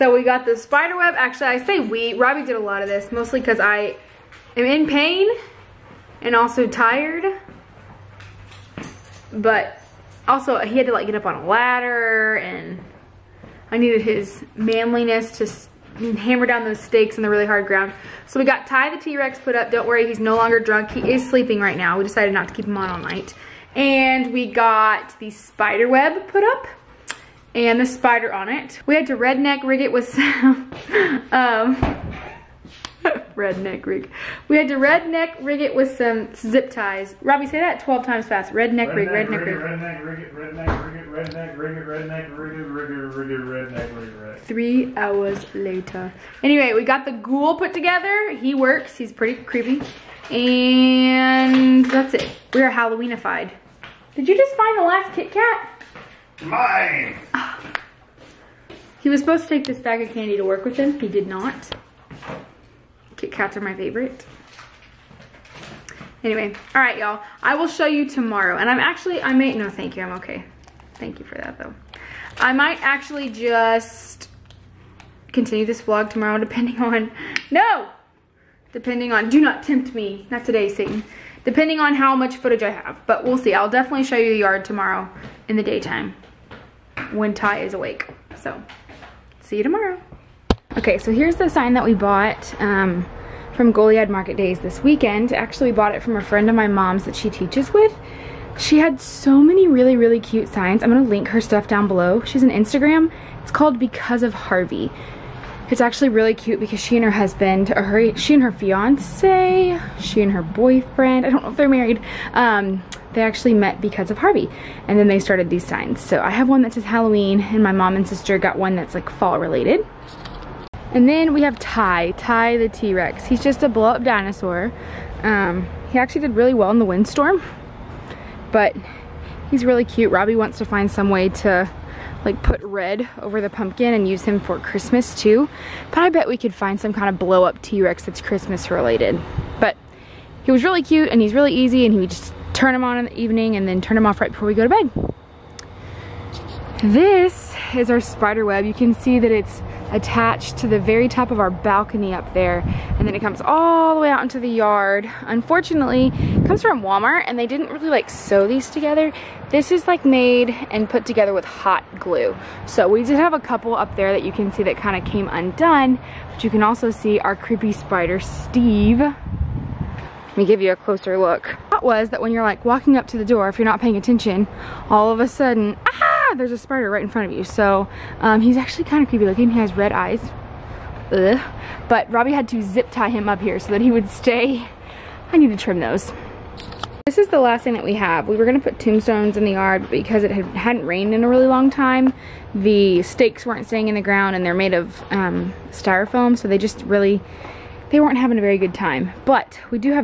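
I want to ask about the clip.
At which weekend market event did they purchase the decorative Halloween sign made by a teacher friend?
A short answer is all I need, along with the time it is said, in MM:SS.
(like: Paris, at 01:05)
Goliad Market Days, at 01:33.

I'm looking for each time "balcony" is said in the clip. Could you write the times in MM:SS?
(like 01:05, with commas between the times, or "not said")
02:31.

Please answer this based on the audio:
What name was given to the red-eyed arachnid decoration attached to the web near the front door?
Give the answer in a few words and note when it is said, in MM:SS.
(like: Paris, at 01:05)
Steve, at 02:47.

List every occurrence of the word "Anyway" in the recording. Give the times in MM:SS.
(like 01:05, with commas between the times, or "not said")
00:46, 01:06.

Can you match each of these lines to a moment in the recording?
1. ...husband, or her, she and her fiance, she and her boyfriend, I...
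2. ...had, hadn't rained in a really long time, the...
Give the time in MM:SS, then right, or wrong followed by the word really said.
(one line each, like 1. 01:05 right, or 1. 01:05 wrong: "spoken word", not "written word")
1. 01:47 right
2. 03:10 right.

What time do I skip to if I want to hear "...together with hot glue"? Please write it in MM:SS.
02:41.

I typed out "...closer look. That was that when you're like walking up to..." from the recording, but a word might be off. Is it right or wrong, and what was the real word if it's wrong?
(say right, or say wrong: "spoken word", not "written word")
right.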